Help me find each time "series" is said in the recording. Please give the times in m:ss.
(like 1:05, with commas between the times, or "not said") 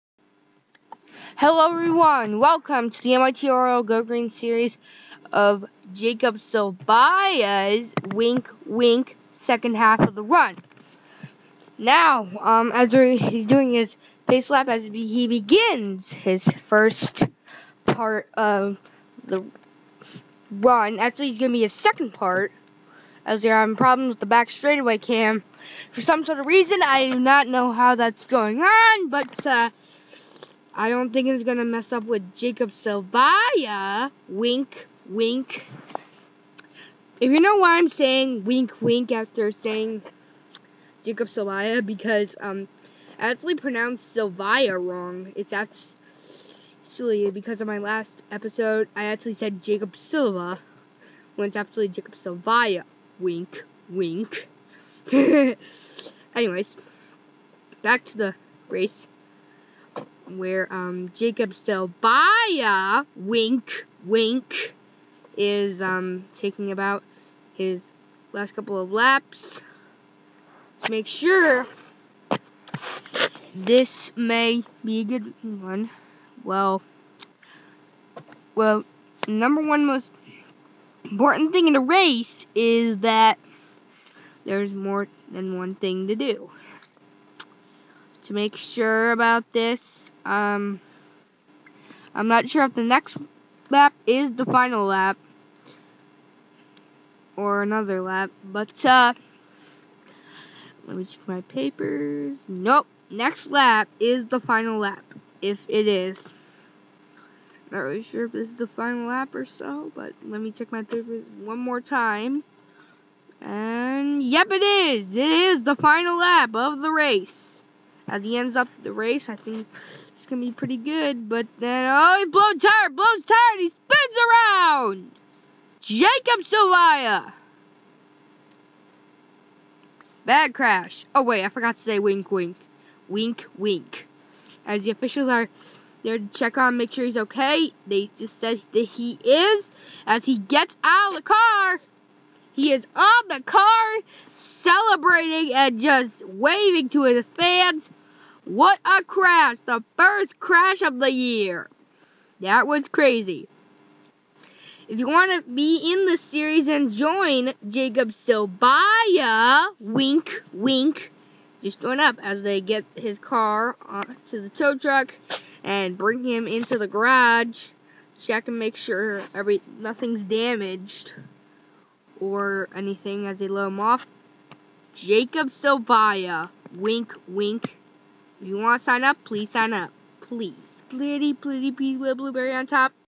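0:04, 2:36.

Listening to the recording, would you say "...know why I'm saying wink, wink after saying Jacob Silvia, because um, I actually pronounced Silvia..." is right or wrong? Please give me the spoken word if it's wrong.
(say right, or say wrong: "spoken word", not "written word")
right.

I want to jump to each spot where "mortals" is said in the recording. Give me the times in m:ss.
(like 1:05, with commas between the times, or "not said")
not said.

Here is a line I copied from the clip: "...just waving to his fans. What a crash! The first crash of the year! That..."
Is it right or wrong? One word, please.
right.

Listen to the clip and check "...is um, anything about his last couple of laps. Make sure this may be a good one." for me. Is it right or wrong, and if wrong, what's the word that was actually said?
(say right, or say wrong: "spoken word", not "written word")
wrong: "taking", not "anything".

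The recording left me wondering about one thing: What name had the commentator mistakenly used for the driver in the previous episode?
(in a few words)
Jacob Silva.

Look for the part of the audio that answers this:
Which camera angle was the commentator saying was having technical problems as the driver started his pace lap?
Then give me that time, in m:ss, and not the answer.
0:24.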